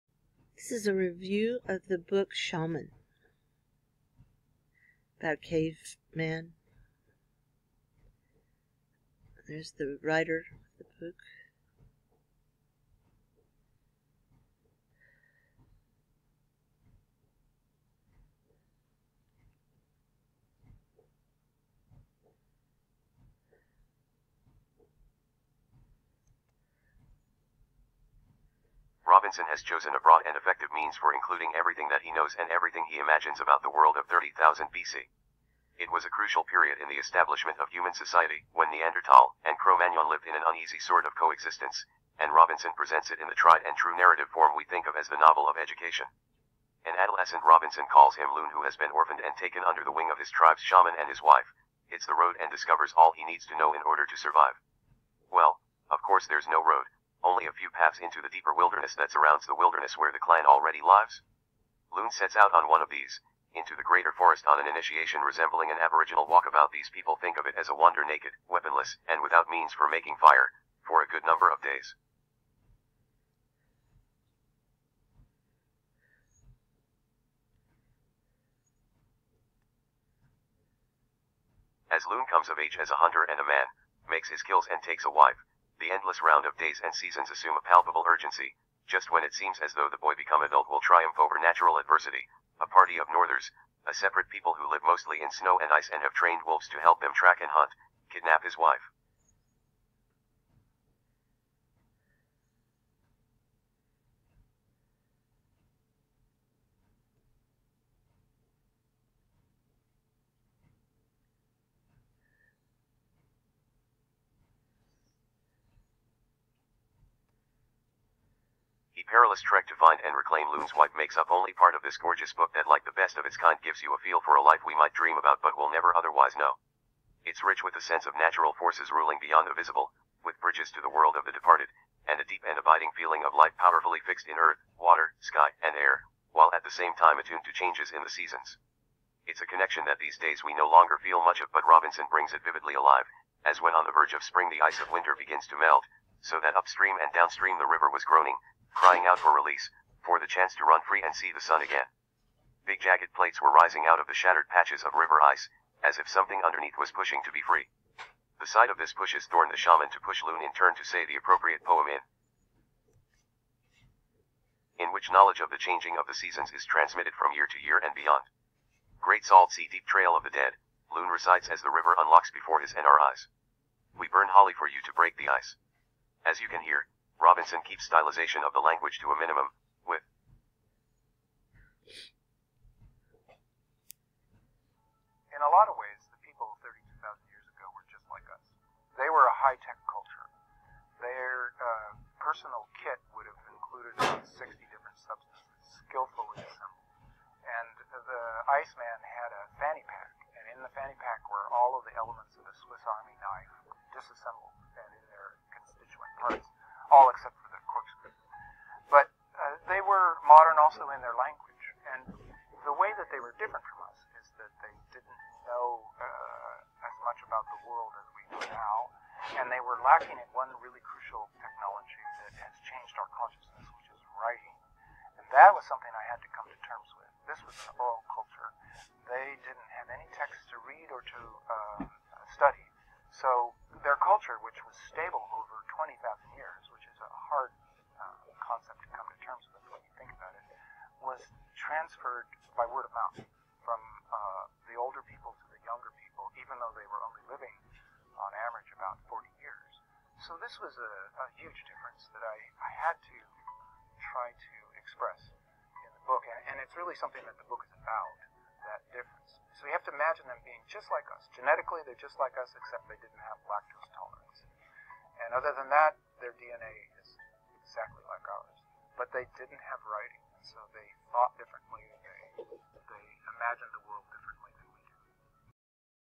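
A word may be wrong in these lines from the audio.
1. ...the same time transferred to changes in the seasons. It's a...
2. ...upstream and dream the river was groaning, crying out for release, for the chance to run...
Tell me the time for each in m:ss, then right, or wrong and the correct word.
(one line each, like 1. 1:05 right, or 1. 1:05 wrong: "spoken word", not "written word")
1. 2:16 wrong: "attuned", not "transferred"
2. 2:26 wrong: "downstream", not "dream".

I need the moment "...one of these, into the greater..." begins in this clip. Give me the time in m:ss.
1:02.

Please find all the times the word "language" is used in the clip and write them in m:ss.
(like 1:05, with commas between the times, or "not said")
2:58, 3:31.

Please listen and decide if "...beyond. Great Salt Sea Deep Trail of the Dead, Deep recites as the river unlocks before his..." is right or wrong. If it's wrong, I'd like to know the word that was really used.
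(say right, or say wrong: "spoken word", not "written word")
wrong: "Loon", not "Deep".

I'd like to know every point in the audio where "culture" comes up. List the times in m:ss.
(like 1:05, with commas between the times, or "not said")
3:09, 3:48, 3:53.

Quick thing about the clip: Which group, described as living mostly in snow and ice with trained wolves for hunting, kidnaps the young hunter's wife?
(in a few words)
northers.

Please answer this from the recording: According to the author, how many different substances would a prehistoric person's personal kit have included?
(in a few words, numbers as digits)
60.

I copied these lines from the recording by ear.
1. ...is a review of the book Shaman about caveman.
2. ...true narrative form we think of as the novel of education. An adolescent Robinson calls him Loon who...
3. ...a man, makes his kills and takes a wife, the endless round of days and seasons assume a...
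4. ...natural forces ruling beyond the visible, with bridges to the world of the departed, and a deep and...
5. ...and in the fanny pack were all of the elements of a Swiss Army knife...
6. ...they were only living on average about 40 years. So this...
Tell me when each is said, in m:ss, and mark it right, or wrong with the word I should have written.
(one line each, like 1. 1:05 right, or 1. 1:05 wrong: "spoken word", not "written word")
1. 0:00 right
2. 0:43 right
3. 1:23 right
4. 2:08 right
5. 3:20 right
6. 4:06 right.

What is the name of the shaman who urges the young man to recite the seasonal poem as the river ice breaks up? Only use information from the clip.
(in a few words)
Thorn.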